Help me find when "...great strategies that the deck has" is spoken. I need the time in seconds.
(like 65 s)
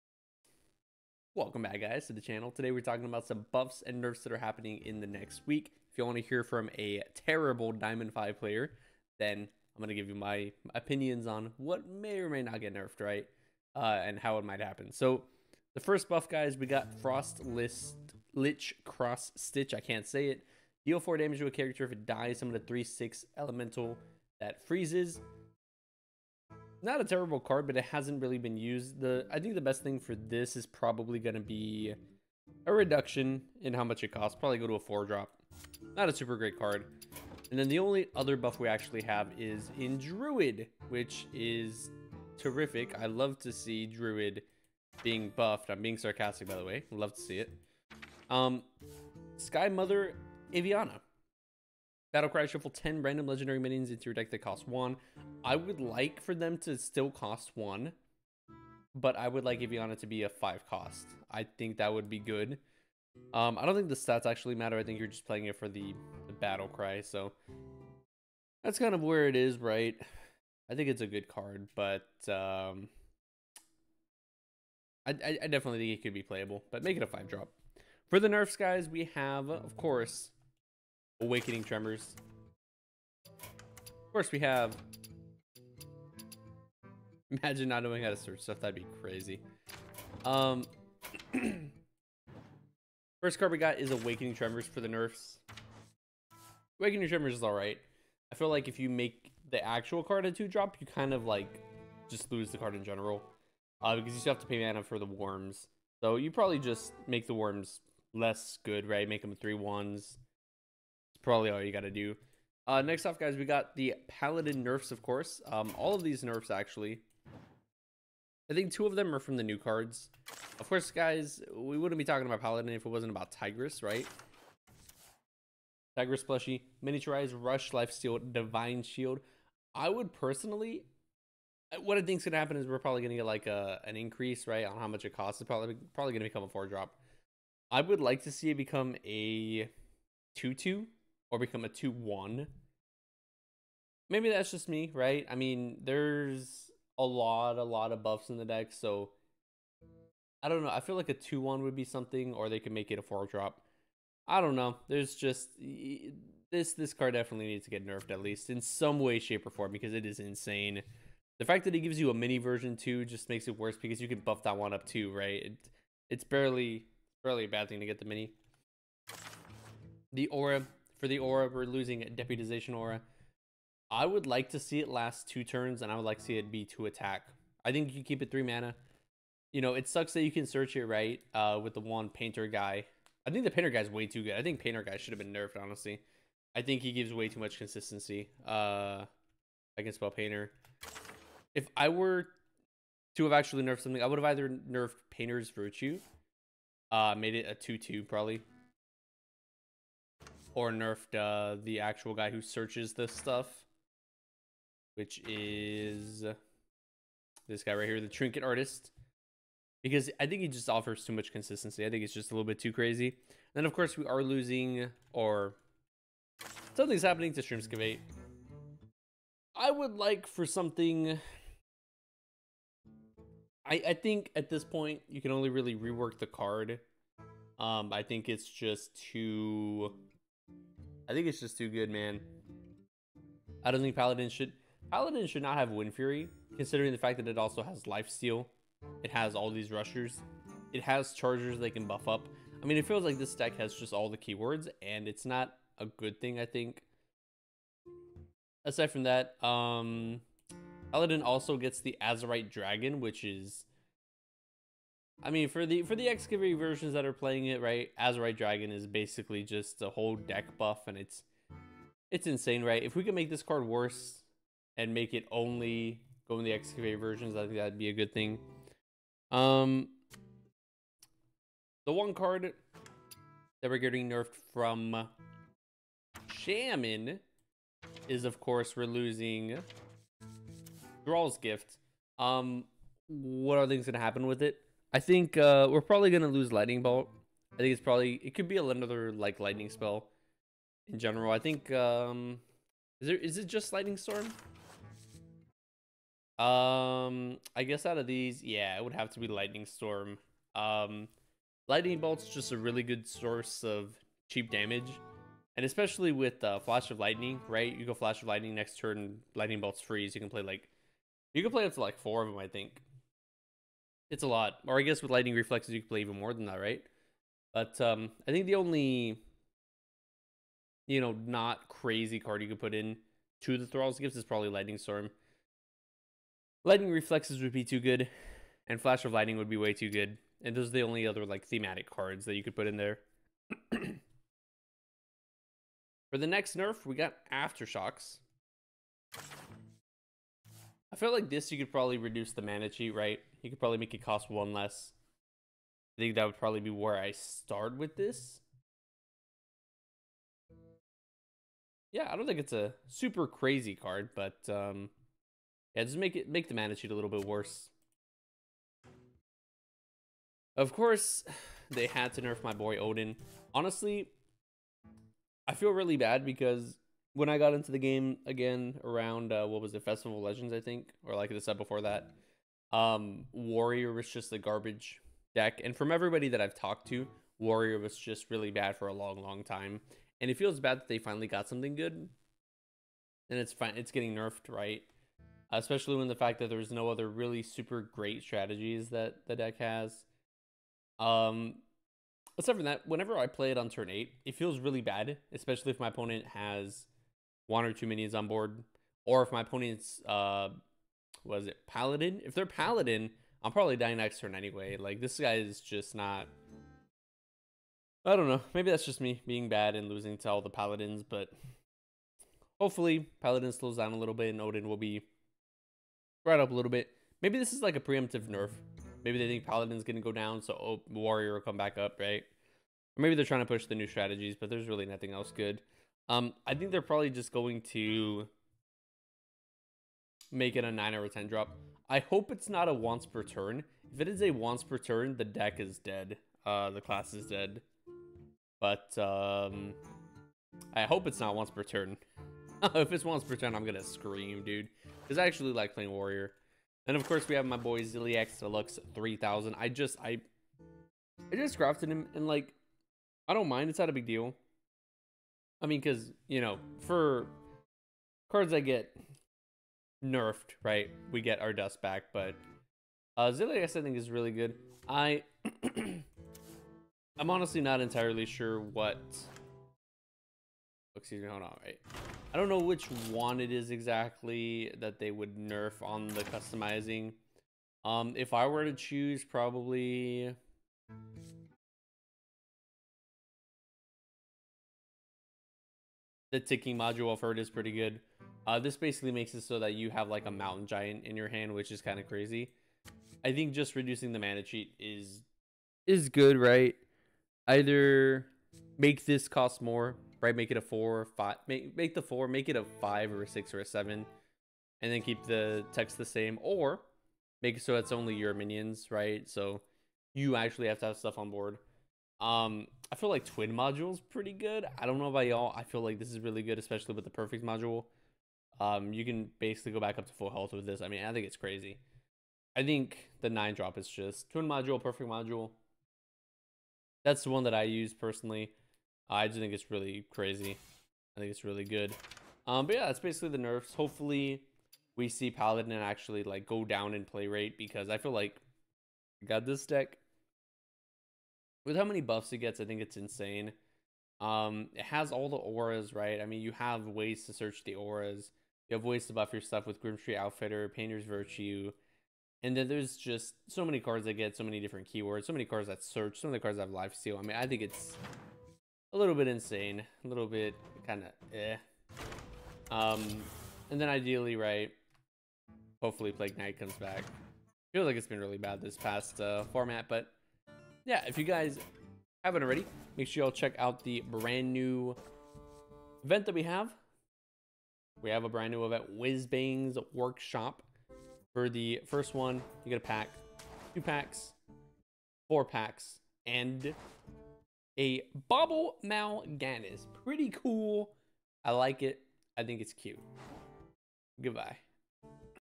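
387 s.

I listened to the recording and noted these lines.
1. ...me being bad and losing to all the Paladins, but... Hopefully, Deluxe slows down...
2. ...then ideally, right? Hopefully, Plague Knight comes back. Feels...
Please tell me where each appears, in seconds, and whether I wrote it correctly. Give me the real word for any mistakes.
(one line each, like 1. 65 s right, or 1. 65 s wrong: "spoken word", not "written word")
1. 409 s wrong: "Paladin", not "Deluxe"
2. 563 s right.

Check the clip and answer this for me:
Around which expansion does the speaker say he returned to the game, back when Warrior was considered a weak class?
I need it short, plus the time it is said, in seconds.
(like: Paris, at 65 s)
Festival of Legends, at 369 s.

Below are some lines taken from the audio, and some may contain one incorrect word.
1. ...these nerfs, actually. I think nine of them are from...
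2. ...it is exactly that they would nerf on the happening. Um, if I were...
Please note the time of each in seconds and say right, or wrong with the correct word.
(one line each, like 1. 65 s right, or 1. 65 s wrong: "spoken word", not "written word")
1. 116 s wrong: "two", not "nine"
2. 473 s wrong: "customizing", not "happening".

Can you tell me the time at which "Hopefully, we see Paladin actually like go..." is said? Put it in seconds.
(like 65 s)
533 s.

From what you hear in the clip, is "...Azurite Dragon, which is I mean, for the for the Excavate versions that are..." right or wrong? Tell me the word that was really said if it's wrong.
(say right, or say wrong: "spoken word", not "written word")
right.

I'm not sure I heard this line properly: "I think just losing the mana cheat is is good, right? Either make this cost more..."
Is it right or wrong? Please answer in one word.
wrong.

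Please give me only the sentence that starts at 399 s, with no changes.
Or if my opponent's, uh, was it Paladin?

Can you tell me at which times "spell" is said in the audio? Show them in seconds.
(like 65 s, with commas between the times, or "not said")
189 s, 289 s.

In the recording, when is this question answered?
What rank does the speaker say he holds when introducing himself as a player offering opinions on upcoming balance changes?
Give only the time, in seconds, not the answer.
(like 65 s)
7 s.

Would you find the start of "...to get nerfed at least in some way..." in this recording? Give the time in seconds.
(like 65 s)
157 s.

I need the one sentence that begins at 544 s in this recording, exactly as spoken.
Um, it has all the auras, right?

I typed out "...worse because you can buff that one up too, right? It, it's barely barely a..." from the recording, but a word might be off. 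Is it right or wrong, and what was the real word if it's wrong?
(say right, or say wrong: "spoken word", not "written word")
right.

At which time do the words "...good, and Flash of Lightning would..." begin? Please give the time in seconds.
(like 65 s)
327 s.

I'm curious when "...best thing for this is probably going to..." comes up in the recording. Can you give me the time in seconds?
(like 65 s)
29 s.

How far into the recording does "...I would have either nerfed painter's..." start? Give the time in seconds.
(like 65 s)
194 s.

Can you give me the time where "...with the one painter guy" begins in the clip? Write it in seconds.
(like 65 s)
181 s.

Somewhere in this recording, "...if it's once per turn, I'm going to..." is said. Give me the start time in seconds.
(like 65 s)
442 s.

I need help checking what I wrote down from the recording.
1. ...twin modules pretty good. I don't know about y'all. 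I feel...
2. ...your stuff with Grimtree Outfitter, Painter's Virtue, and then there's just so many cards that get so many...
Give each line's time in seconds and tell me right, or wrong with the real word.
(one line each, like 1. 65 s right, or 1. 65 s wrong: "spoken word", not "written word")
1. 513 s right
2. 549 s right.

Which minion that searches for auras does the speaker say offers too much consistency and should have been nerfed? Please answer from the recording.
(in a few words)
Trinket Artist.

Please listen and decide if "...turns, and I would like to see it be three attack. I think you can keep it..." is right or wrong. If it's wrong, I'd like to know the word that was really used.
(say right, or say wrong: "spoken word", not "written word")
wrong: "two", not "three".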